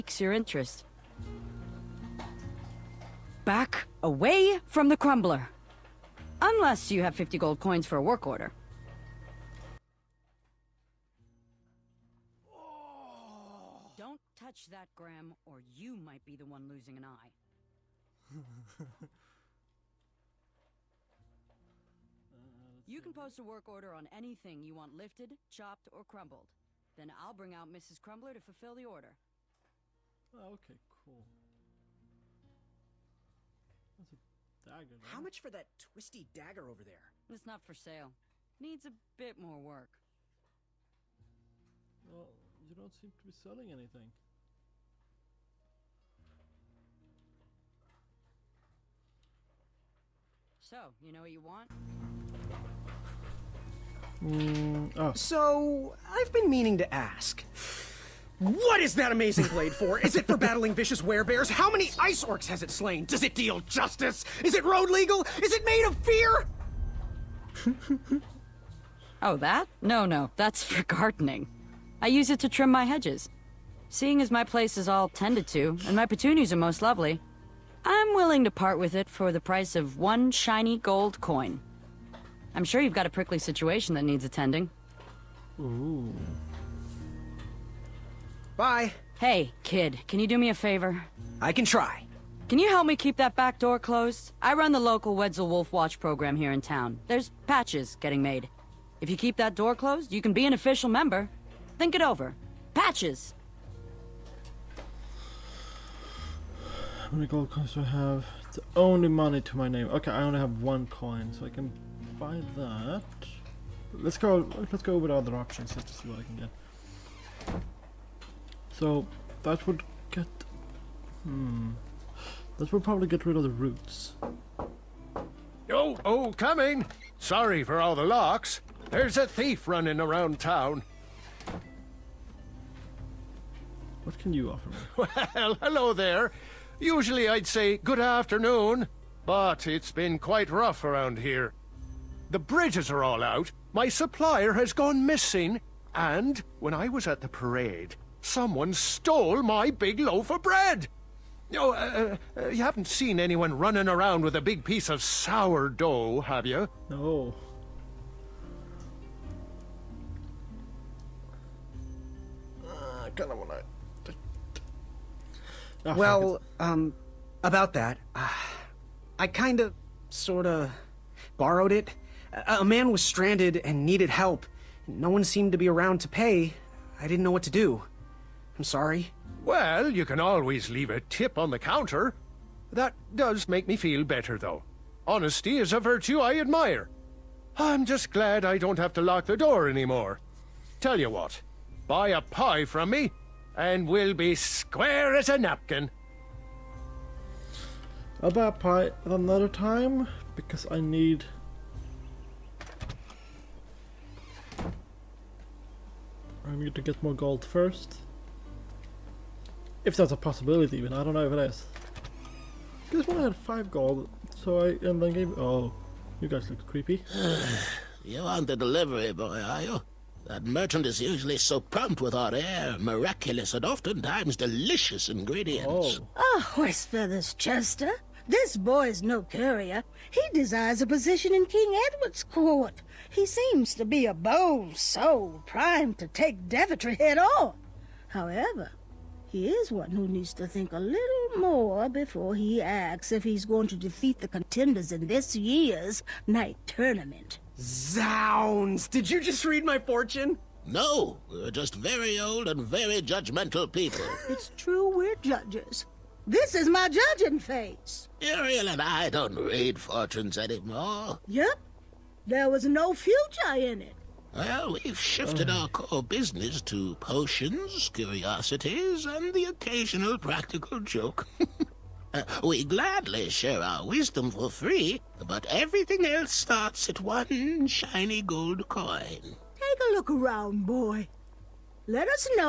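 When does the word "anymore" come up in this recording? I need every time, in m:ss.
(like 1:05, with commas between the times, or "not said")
3:09, 4:20.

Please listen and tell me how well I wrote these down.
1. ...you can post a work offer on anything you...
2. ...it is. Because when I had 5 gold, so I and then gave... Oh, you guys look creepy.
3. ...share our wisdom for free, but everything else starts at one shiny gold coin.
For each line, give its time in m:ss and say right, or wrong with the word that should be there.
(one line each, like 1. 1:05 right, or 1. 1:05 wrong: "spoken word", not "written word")
1. 0:22 wrong: "order", not "offer"
2. 3:31 right
3. 4:33 right.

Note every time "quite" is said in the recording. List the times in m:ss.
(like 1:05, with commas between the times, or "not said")
2:20.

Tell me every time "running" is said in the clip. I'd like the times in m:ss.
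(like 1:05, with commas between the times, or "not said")
2:09, 2:33.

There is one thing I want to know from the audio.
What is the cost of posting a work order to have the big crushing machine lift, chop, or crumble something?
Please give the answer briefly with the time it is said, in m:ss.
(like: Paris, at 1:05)
50 gold coins, at 0:07.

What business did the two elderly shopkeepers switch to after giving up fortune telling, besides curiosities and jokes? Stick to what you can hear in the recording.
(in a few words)
Potions.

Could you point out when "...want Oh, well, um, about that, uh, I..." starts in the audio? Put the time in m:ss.
2:43.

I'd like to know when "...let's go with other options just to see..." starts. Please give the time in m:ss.
1:54.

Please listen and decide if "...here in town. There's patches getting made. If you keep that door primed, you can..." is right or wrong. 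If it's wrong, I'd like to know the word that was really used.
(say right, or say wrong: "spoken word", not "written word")
wrong: "closed", not "primed".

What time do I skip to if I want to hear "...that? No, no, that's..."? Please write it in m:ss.
1:09.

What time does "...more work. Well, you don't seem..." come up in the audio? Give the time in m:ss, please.
0:39.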